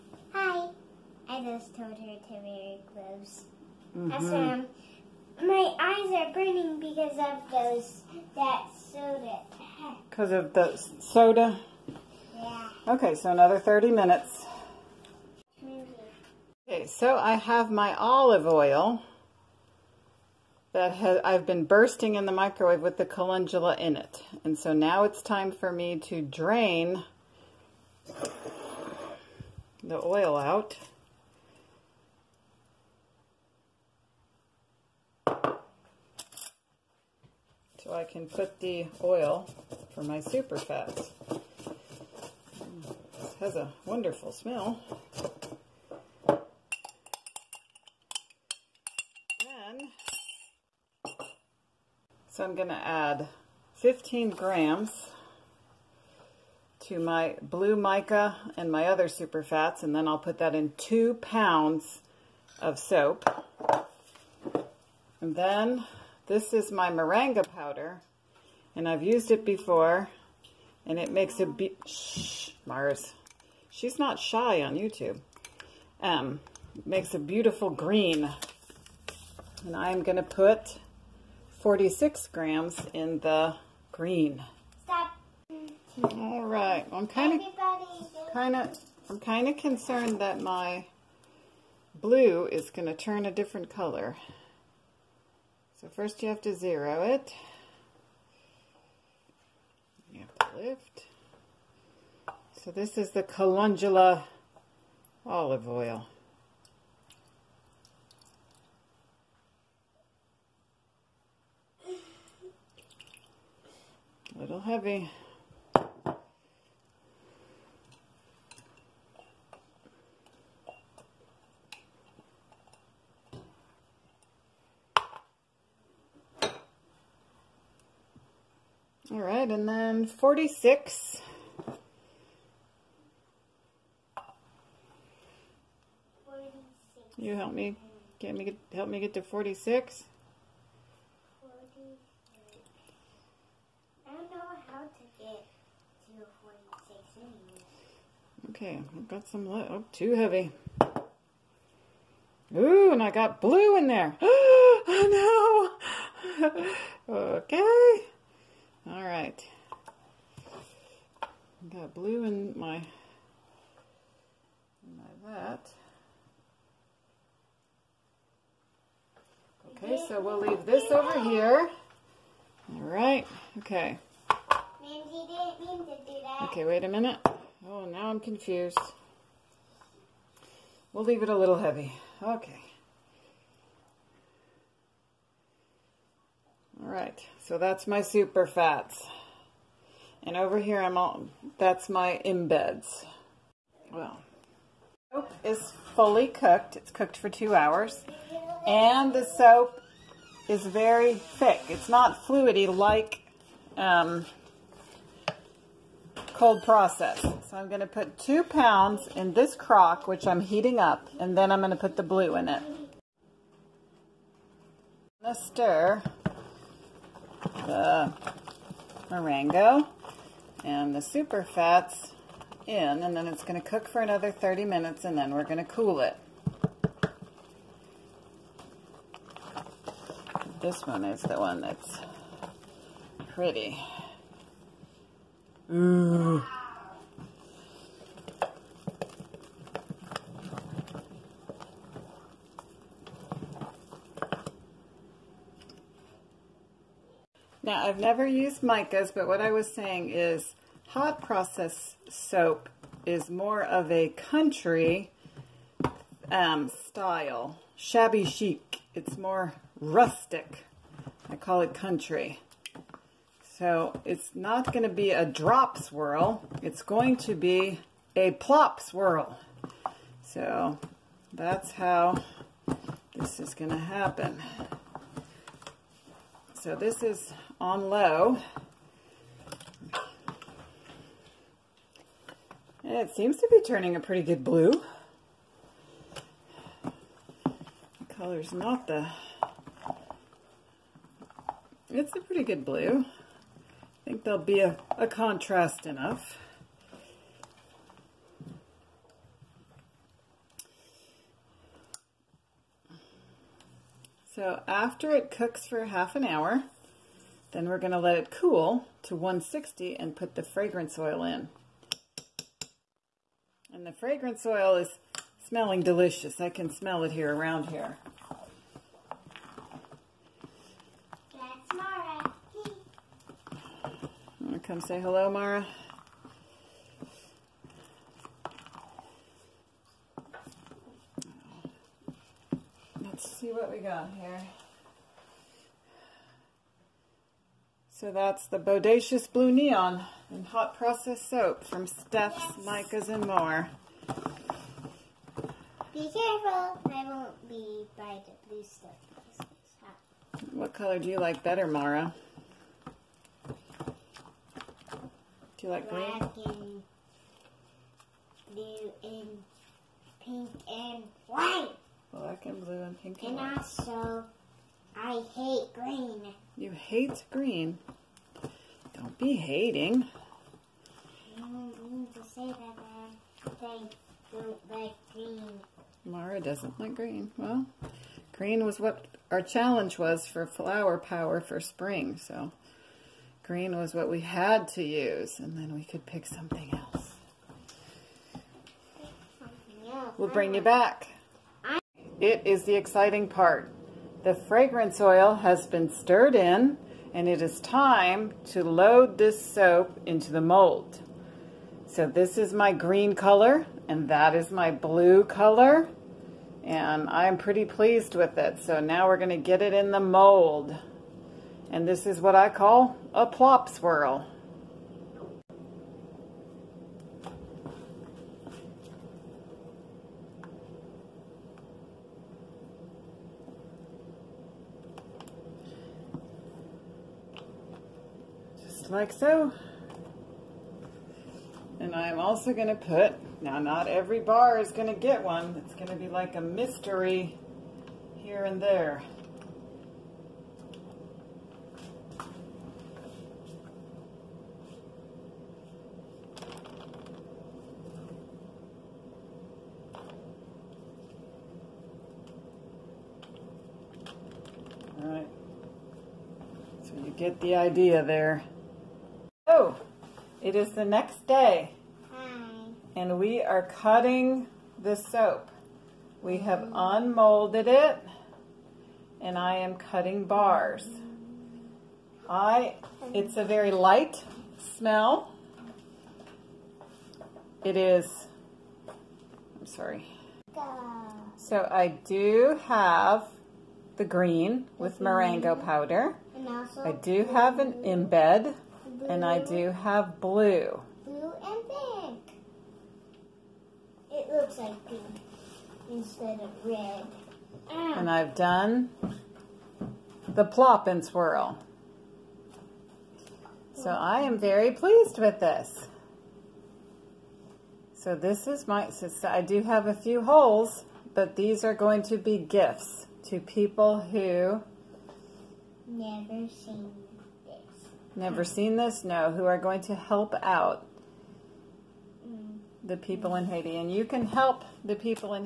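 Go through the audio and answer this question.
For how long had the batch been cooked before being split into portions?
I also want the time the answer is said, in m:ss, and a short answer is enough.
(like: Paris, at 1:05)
2 hours, at 3:17.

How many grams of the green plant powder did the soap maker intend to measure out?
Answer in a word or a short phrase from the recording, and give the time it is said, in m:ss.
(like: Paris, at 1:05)
46, at 1:21.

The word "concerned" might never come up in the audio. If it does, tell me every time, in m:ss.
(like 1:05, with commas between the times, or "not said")
1:29.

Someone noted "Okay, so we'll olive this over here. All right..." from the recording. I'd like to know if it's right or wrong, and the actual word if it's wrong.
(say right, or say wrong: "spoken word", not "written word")
wrong: "leave", not "olive".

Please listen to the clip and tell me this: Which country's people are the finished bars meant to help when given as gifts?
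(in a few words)
Haiti.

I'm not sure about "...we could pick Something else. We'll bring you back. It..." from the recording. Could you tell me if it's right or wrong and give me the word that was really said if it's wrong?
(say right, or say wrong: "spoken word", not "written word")
right.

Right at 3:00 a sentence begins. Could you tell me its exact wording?
We'll leave it a little heavy.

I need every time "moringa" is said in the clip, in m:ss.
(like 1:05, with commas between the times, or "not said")
1:06, 3:39, 8:04.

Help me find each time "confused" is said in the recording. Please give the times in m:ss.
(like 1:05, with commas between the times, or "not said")
2:58.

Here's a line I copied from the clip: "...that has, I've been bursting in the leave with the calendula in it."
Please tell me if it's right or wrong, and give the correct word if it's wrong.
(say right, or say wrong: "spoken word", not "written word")
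wrong: "microwave", not "leave".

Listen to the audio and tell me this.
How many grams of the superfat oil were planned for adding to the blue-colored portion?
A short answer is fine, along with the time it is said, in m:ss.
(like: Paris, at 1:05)
15 grams, at 0:53.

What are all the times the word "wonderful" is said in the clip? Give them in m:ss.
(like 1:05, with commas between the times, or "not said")
0:43.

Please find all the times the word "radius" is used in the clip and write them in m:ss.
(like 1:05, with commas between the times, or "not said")
not said.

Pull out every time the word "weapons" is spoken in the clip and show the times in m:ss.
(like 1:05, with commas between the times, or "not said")
not said.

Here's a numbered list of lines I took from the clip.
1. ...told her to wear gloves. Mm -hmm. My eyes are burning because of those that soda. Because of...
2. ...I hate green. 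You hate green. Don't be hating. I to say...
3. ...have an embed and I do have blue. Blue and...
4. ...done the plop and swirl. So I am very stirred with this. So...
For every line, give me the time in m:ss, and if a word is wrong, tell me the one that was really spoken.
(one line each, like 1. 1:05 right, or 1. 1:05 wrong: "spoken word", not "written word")
1. 0:01 right
2. 6:04 right
3. 8:07 right
4. 8:18 wrong: "pleased", not "stirred".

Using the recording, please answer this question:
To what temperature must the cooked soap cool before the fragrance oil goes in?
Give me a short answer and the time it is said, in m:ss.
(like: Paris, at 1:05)
160, at 5:09.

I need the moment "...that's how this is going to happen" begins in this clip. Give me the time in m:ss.
4:31.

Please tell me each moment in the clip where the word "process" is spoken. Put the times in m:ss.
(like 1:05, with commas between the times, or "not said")
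3:26, 4:11, 5:40.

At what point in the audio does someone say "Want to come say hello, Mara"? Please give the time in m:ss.
5:24.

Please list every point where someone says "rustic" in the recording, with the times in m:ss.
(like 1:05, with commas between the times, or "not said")
4:19.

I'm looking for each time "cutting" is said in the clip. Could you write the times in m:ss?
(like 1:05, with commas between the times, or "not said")
7:43, 7:49.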